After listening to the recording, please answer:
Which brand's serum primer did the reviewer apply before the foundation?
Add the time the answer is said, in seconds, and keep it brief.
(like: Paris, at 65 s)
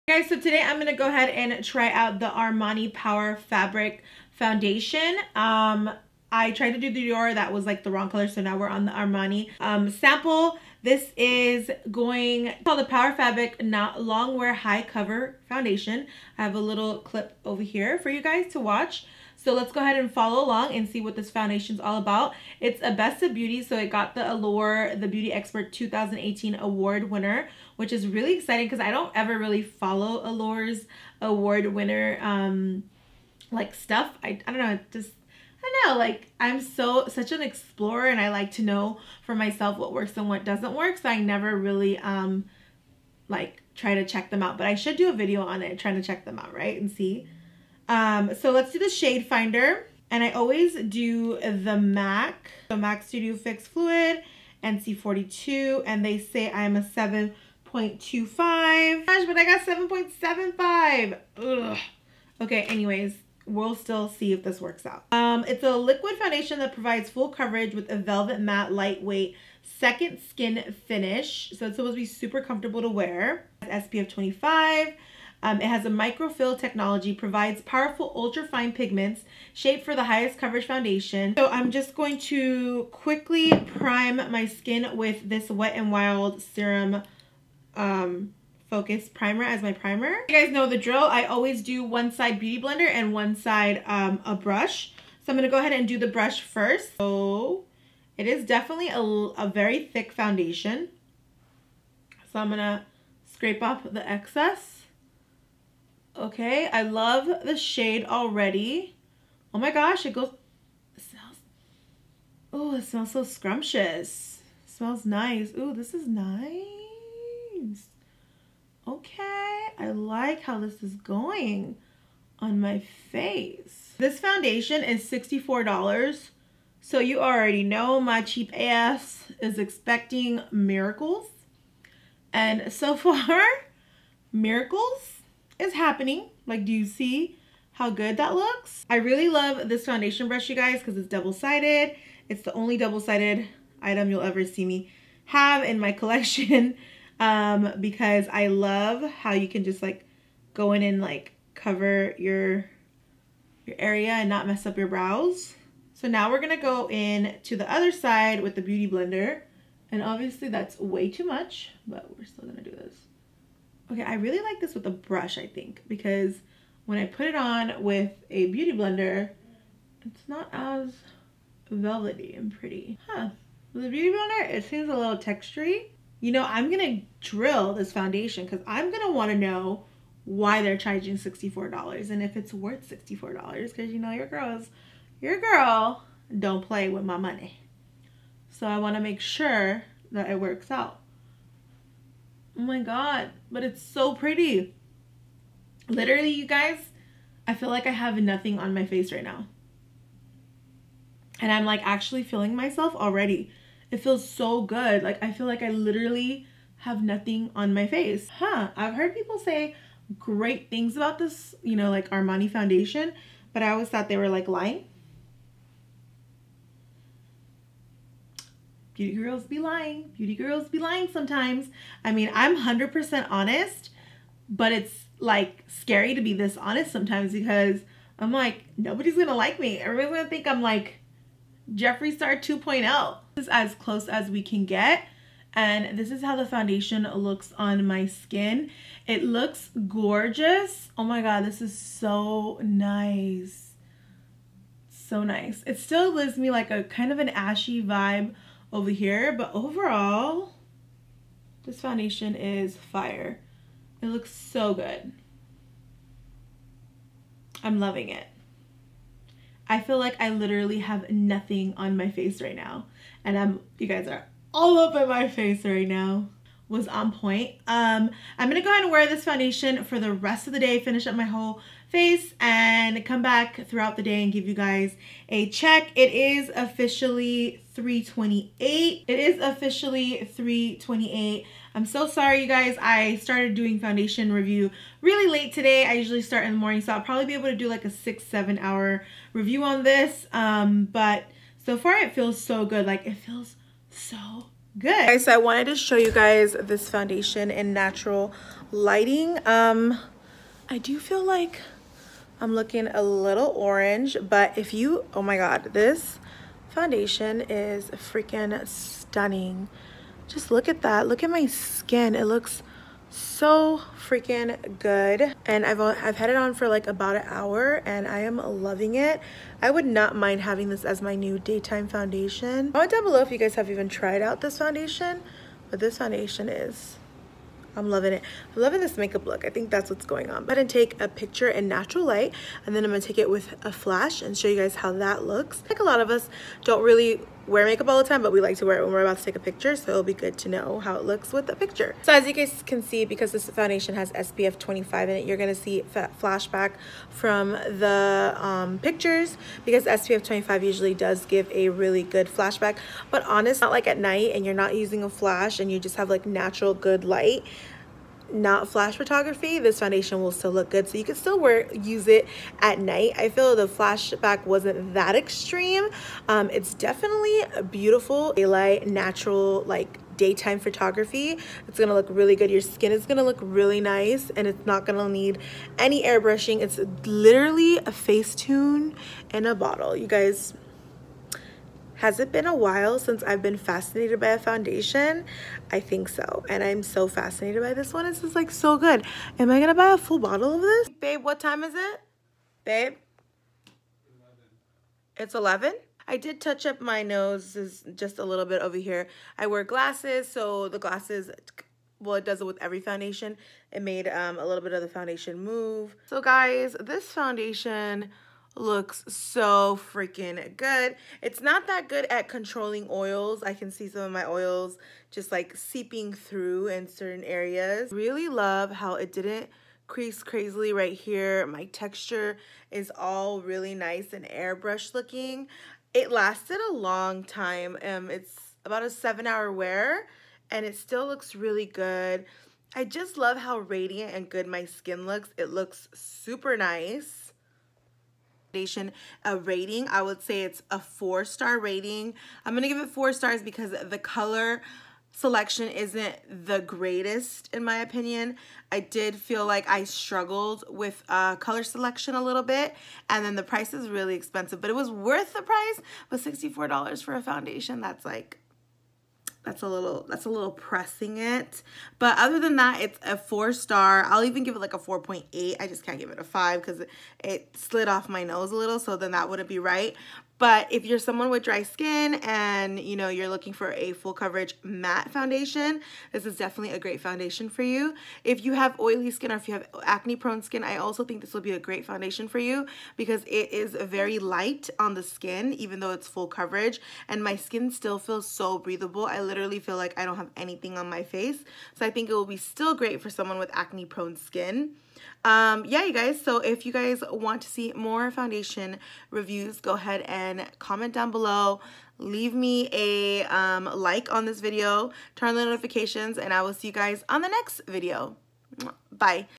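Wet n Wild, at 85 s.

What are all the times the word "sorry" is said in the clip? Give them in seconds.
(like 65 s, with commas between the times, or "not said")
282 s.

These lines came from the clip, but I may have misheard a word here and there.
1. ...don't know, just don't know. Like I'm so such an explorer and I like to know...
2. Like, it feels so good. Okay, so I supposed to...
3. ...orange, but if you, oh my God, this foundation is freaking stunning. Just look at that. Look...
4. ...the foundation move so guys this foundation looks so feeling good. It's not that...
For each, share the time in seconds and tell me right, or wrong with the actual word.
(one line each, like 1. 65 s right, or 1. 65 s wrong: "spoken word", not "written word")
1. 34 s right
2. 292 s wrong: "wanted", not "supposed"
3. 303 s right
4. 404 s wrong: "freaking", not "feeling".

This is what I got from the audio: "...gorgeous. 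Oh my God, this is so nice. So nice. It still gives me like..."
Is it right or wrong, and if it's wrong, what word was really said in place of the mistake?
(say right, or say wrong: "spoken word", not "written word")
right.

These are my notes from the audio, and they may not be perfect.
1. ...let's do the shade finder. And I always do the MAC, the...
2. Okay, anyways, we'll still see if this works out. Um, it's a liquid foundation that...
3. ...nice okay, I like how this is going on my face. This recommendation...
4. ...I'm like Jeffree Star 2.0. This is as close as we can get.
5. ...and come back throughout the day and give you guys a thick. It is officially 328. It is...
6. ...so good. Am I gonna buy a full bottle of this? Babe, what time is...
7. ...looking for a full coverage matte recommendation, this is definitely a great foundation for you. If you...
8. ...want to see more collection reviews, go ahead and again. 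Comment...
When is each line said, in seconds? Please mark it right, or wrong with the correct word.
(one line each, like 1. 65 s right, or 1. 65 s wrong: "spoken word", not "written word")
1. 48 s right
2. 62 s right
3. 116 s wrong: "foundation", not "recommendation"
4. 230 s right
5. 272 s wrong: "check", not "thick"
6. 388 s right
7. 473 s wrong: "foundation", not "recommendation"
8. 497 s wrong: "foundation", not "collection".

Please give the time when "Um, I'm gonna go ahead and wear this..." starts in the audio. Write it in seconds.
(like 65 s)
267 s.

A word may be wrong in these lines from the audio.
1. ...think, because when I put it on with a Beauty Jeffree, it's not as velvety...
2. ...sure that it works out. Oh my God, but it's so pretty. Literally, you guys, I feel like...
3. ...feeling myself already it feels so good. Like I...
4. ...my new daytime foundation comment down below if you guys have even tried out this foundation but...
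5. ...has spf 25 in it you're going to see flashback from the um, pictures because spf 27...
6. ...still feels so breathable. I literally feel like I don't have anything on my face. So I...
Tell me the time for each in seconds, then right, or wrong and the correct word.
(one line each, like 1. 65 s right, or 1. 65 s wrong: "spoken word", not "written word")
1. 165 s wrong: "Blender", not "Jeffree"
2. 189 s right
3. 202 s right
4. 321 s right
5. 343 s wrong: "25", not "27"
6. 487 s right.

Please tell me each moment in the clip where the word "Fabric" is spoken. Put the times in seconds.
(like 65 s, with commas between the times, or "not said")
3 s, 13 s.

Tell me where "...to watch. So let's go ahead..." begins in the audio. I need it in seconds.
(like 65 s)
18 s.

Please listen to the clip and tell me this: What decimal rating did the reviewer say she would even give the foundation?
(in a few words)
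4.8.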